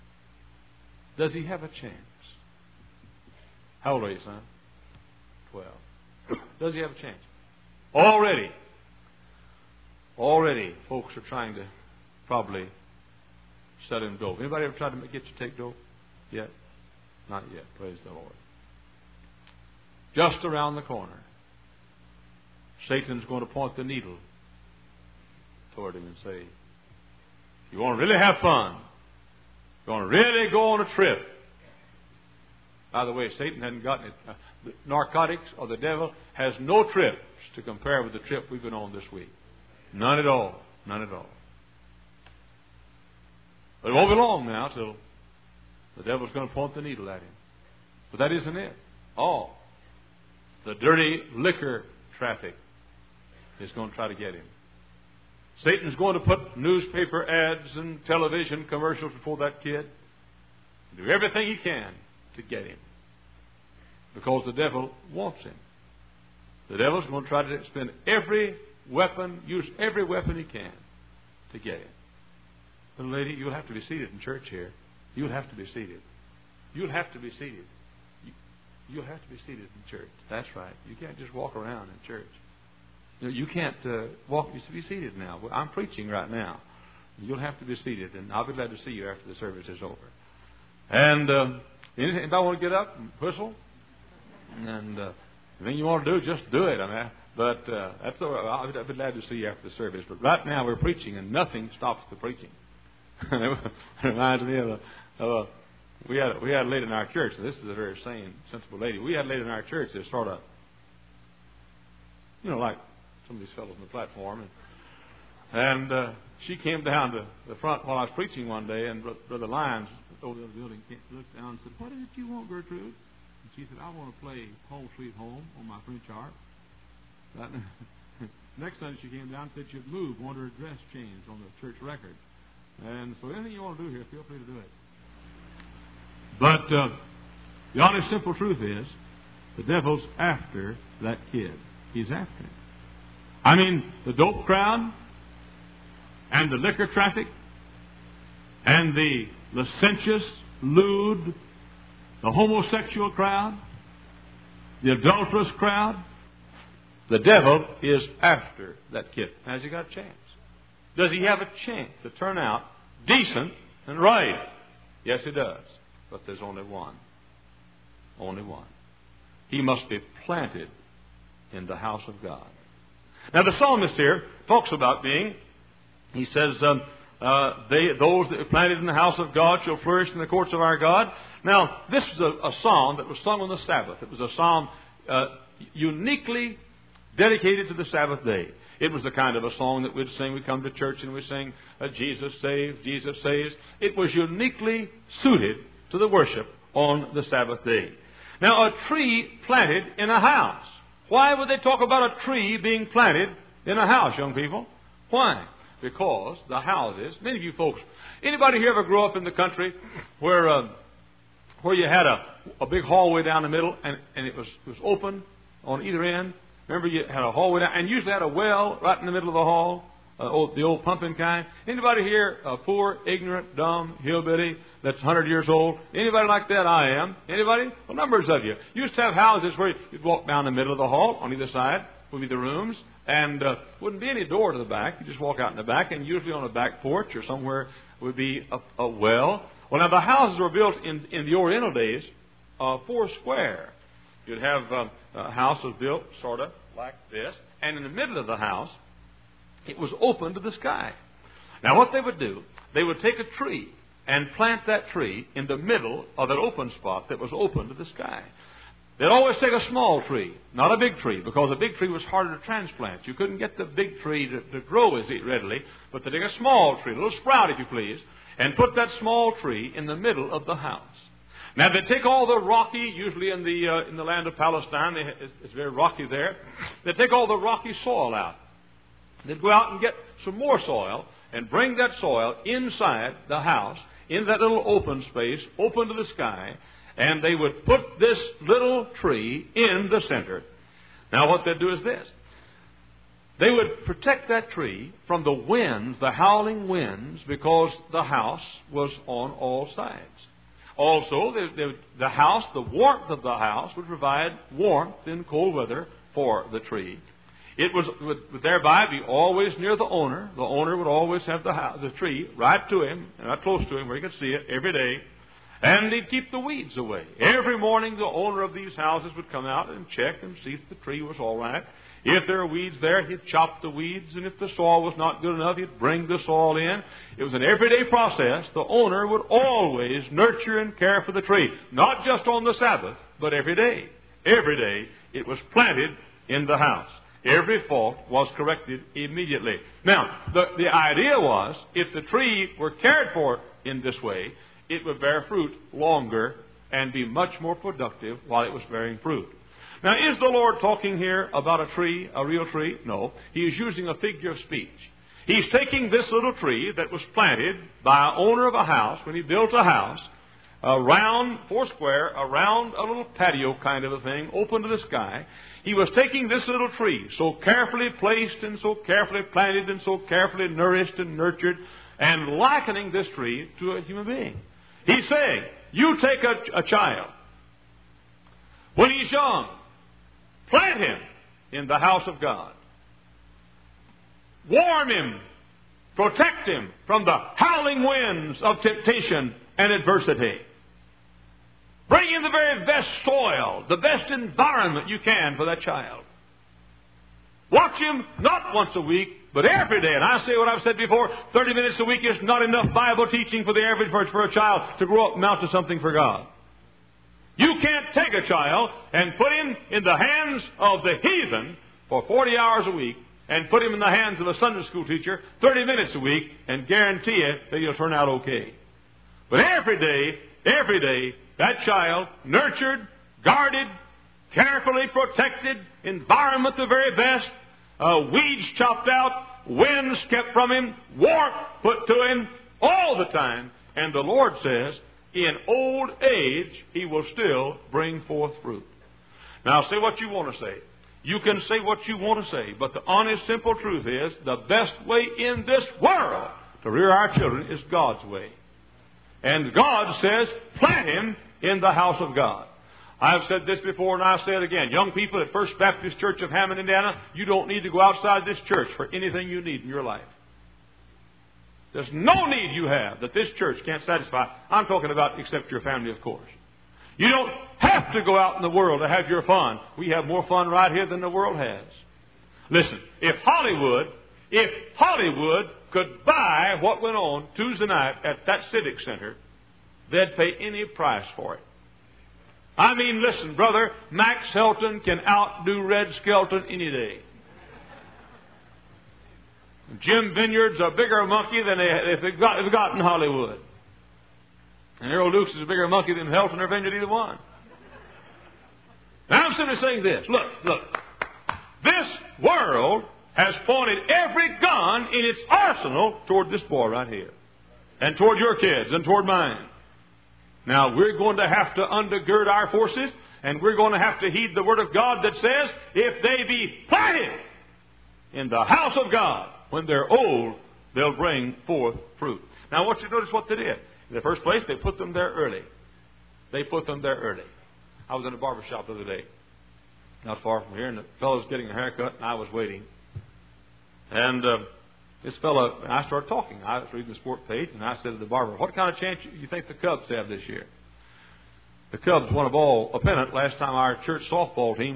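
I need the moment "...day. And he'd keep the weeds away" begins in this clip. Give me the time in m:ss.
5:14.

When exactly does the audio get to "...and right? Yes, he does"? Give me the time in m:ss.
2:43.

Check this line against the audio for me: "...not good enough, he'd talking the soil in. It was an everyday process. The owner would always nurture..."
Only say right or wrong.
wrong.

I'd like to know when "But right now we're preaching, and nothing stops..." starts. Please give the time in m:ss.
1:40.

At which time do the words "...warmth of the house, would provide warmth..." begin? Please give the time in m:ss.
5:02.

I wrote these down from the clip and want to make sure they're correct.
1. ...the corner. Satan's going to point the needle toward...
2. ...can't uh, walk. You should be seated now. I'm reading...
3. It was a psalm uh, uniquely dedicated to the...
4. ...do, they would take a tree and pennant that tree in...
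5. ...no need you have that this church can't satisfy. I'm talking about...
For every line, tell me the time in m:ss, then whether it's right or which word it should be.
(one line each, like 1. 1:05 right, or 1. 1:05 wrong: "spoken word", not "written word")
1. 0:20 right
2. 1:23 wrong: "preaching", not "reading"
3. 3:04 right
4. 4:12 wrong: "plant", not "pennant"
5. 7:41 right.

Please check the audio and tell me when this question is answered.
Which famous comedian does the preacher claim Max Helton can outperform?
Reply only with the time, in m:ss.
8:05.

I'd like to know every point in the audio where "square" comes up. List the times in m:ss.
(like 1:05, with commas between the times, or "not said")
4:03, 6:01.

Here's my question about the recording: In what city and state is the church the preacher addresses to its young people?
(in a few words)
Hammond, Indiana.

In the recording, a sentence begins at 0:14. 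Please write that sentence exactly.
Anybody ever tried to get you to take dope?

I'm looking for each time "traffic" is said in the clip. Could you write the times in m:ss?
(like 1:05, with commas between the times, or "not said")
0:52, 2:26.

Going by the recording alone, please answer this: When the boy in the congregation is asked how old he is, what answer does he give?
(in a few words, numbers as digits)
12.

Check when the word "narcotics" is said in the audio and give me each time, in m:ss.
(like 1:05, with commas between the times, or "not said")
0:34.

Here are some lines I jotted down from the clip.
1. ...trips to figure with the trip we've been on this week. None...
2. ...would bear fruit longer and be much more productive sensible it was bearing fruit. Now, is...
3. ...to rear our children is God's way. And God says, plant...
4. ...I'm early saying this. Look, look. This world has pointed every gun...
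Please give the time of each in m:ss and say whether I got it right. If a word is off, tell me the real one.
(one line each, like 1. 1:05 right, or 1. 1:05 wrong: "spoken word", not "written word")
1. 0:36 wrong: "compare", not "figure"
2. 5:44 wrong: "while", not "sensible"
3. 7:26 right
4. 8:19 wrong: "simply", not "early".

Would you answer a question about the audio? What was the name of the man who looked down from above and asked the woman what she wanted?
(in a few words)
Brother Lyons.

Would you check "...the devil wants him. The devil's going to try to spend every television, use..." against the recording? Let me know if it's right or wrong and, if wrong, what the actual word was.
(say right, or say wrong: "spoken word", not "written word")
wrong: "weapon", not "television".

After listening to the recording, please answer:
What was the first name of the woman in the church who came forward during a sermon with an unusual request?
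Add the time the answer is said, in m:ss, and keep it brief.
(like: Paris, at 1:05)
Gertrude, at 2:02.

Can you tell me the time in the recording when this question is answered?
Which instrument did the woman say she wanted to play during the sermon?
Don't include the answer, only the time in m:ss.
2:05.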